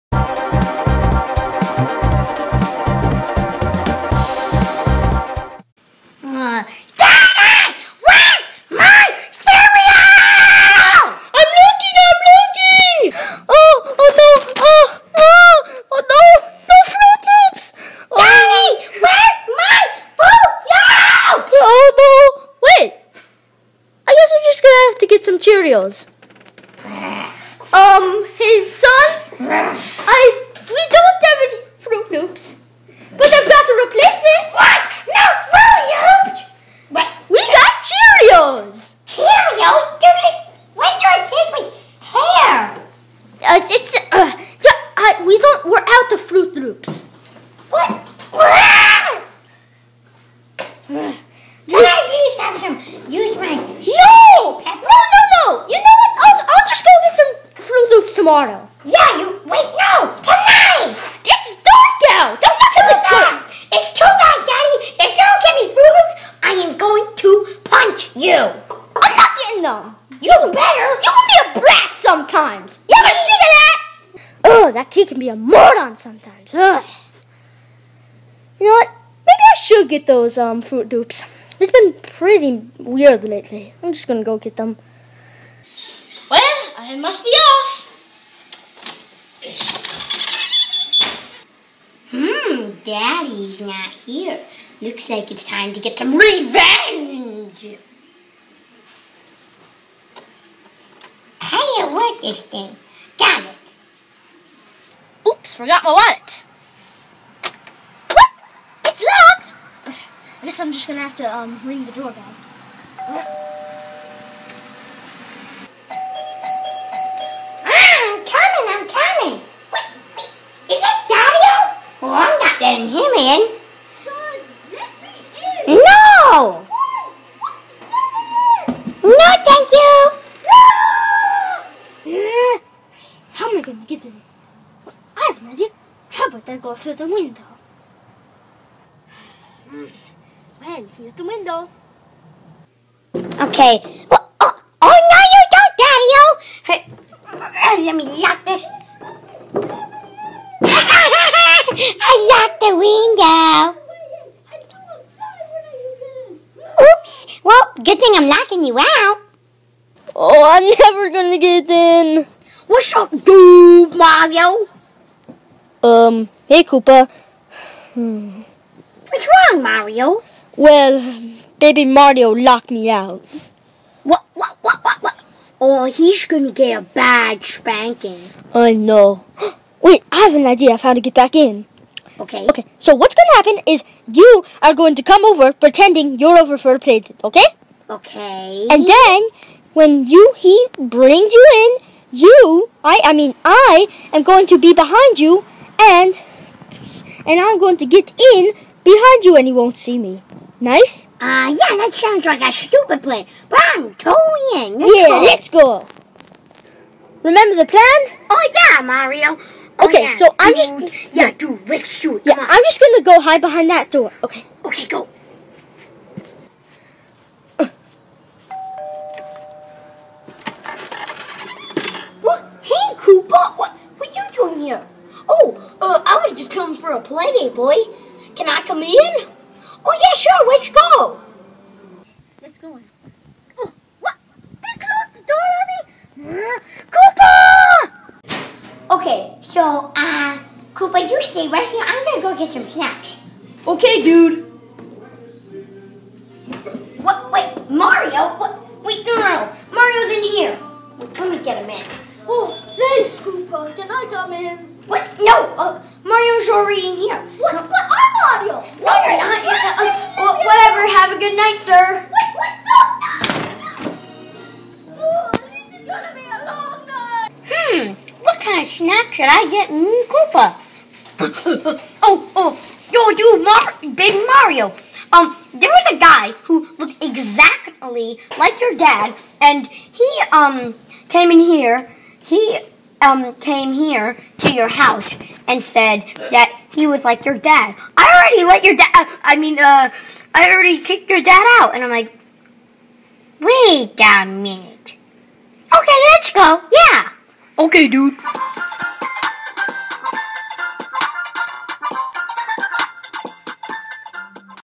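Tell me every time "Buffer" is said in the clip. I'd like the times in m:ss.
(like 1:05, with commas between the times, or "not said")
not said.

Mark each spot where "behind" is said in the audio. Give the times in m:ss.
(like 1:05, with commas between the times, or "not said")
3:14, 3:18, 3:33.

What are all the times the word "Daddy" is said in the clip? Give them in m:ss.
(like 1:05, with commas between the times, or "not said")
1:04, 1:32, 2:27.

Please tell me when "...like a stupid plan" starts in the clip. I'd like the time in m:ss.
3:22.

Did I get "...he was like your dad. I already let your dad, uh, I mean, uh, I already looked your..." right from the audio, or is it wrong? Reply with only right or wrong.
wrong.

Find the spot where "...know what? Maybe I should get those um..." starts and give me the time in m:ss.
1:18.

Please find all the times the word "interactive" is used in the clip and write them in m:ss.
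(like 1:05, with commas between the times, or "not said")
not said.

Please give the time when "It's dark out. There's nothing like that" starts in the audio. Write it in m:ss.
1:01.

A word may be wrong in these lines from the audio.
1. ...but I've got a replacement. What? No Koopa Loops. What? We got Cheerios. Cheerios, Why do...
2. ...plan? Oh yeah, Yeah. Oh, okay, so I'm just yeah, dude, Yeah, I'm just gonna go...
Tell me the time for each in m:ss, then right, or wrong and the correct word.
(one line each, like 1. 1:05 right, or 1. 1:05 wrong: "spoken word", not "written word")
1. 0:33 wrong: "Froot", not "Koopa"
2. 3:27 wrong: "Mario", not "Yeah".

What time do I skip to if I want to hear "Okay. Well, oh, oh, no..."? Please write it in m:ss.
2:23.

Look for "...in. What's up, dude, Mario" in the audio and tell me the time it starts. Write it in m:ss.
2:41.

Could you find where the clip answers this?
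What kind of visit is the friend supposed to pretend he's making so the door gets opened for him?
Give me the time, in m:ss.
3:47.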